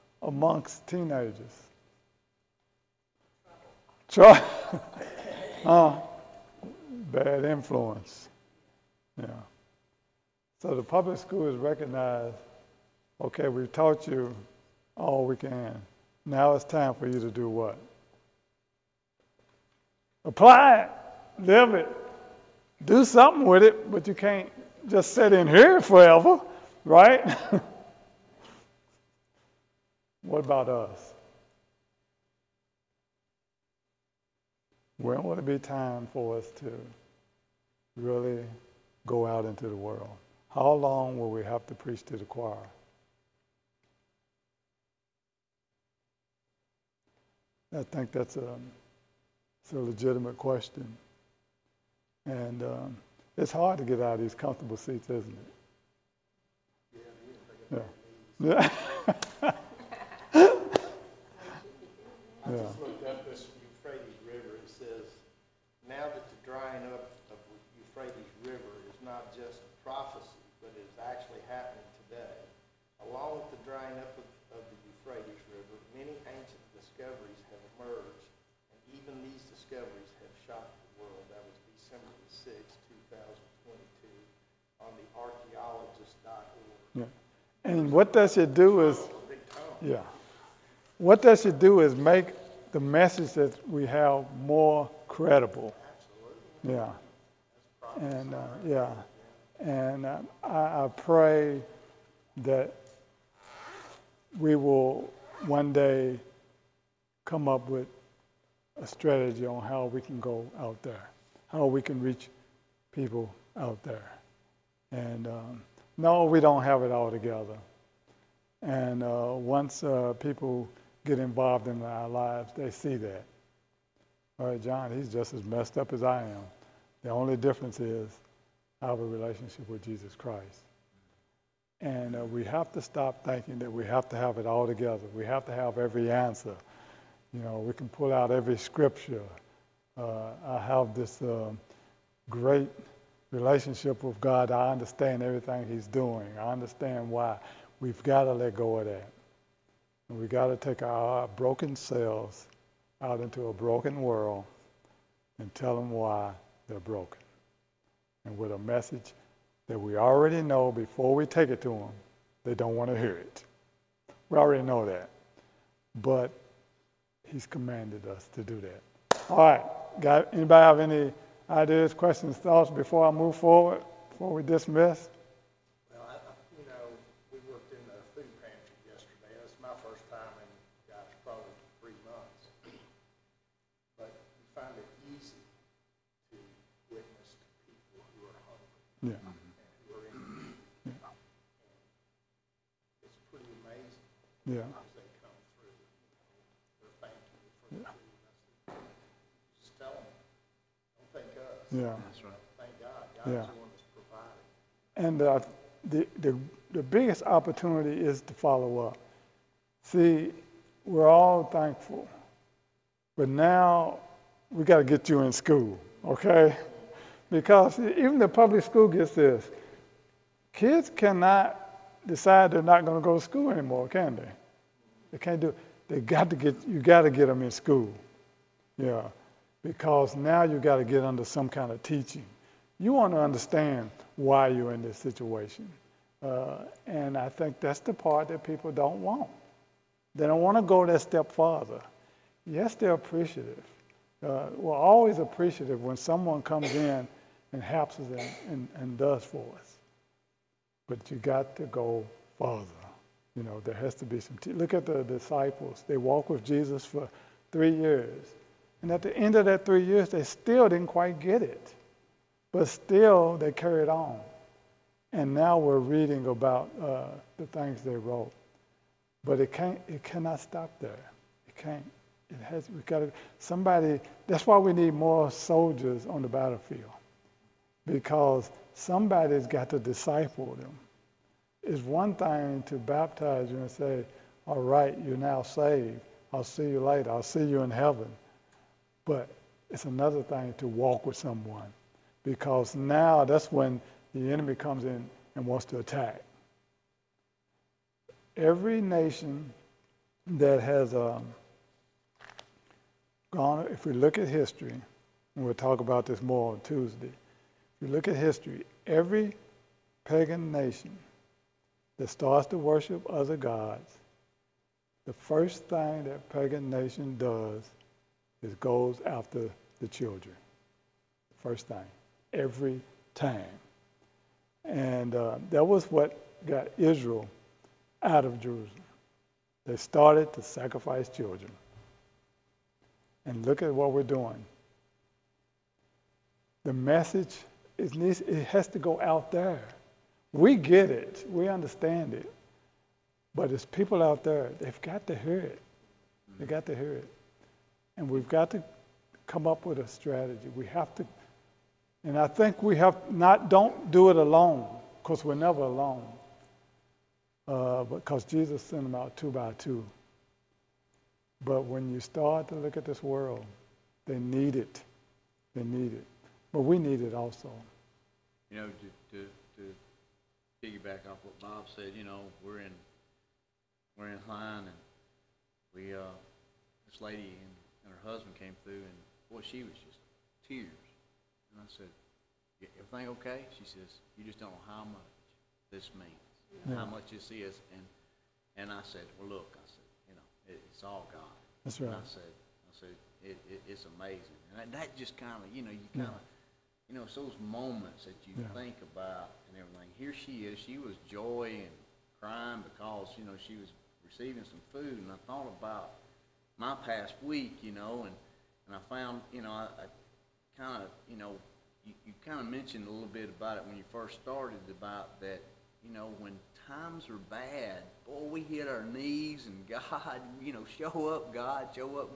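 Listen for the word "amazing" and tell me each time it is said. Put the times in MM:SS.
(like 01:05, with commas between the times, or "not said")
06:33.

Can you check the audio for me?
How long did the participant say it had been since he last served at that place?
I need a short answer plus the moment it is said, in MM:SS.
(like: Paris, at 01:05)
3 months, at 03:01.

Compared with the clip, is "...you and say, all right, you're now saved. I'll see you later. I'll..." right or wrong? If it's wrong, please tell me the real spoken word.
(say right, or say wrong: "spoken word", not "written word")
right.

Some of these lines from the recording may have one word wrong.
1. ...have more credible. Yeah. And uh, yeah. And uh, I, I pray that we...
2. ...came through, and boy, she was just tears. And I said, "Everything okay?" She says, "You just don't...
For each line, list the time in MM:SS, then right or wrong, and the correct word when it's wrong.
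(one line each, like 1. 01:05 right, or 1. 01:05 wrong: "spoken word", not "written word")
1. 01:33 right
2. 06:18 right.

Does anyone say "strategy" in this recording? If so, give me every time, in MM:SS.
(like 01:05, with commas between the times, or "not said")
01:48, 05:49.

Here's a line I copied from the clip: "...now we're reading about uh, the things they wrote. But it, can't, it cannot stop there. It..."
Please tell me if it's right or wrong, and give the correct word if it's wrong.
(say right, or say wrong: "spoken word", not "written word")
right.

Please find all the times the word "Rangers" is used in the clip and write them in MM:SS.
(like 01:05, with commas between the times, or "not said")
not said.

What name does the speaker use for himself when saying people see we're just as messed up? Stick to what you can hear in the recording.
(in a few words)
John.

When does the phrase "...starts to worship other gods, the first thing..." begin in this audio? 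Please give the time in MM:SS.
05:12.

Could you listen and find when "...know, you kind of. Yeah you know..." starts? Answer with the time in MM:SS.
06:35.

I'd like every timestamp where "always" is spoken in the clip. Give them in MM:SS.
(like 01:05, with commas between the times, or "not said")
04:04.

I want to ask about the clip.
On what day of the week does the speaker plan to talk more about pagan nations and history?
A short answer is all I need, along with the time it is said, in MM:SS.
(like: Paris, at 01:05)
Tuesday, at 05:06.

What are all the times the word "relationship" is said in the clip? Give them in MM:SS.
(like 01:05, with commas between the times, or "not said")
02:09, 02:23.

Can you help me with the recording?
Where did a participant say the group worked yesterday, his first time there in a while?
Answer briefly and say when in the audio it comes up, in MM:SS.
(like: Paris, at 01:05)
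Food pantry, at 02:58.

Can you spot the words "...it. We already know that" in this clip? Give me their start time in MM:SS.
02:43.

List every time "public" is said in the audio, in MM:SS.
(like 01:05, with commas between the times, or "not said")
00:10, 03:38.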